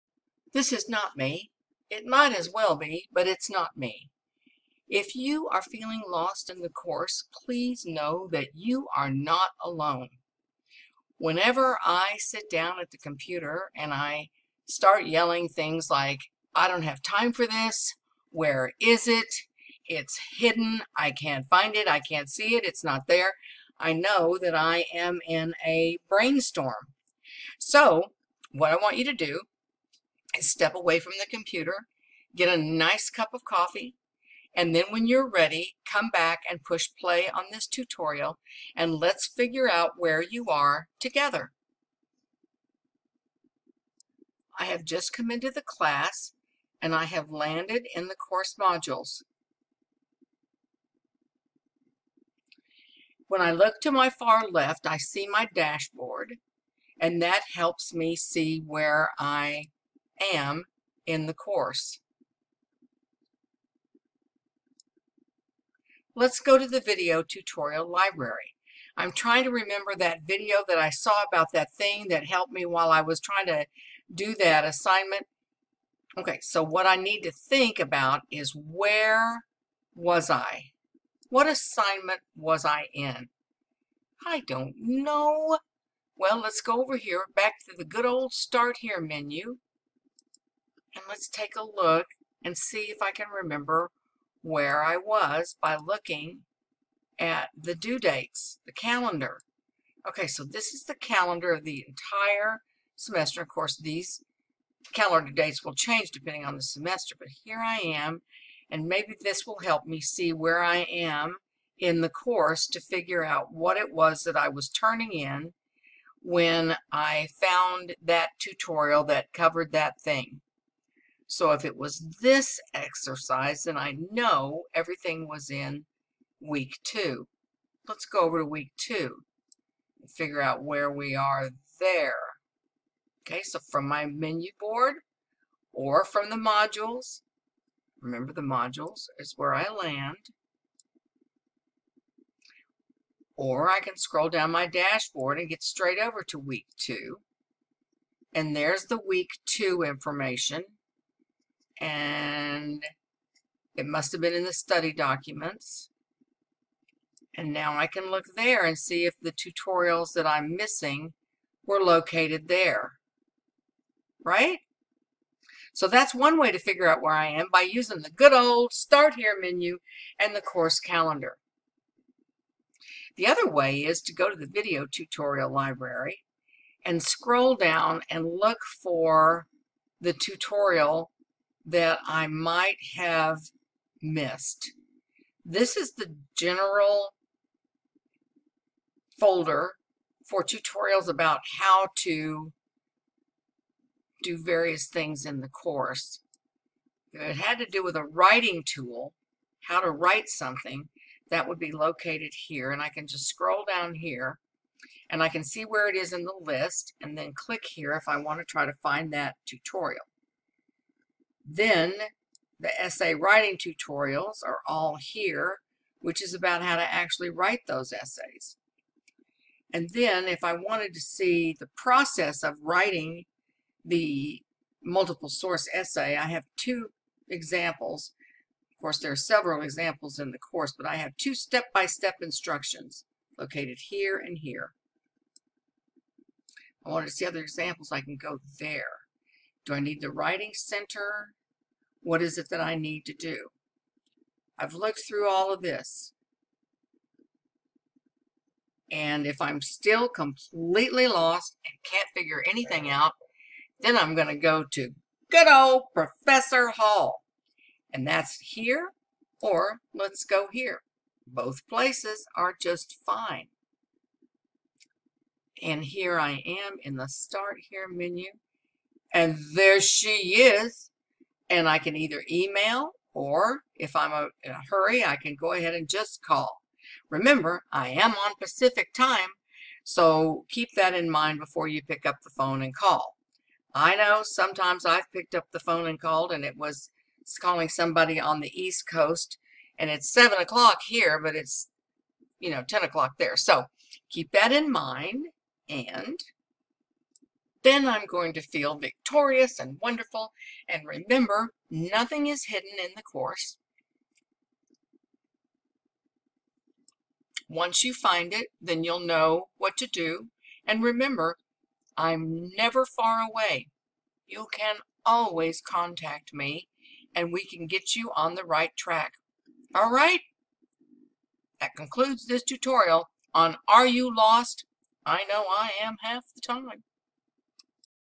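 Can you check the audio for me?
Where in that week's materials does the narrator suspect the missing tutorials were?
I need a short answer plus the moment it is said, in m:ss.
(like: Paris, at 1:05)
Study documents, at 2:34.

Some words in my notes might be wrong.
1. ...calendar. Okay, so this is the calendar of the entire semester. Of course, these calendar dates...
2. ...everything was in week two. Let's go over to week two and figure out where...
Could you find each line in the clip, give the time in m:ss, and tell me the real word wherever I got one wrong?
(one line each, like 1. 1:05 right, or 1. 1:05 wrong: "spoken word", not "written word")
1. 1:38 right
2. 2:04 right.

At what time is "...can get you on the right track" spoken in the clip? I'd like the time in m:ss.
5:17.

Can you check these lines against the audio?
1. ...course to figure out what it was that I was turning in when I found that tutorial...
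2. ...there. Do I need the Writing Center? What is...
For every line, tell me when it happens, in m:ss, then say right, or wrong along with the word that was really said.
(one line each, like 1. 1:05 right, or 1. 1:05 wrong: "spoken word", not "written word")
1. 1:52 right
2. 3:58 right.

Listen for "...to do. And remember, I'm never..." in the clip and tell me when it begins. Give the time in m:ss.
5:09.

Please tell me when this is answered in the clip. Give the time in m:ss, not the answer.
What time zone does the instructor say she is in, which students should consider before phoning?
4:38.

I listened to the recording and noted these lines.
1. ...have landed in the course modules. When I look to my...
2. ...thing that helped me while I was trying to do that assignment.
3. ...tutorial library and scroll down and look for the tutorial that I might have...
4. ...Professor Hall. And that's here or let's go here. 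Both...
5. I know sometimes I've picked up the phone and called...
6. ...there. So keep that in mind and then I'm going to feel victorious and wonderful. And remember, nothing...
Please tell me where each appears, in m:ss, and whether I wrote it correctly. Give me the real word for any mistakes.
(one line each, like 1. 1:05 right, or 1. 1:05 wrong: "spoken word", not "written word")
1. 0:47 right
2. 1:11 right
3. 2:54 right
4. 4:15 right
5. 4:43 right
6. 4:53 right.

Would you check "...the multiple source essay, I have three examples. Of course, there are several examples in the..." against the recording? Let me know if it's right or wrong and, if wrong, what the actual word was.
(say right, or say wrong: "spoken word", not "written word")
wrong: "two", not "three".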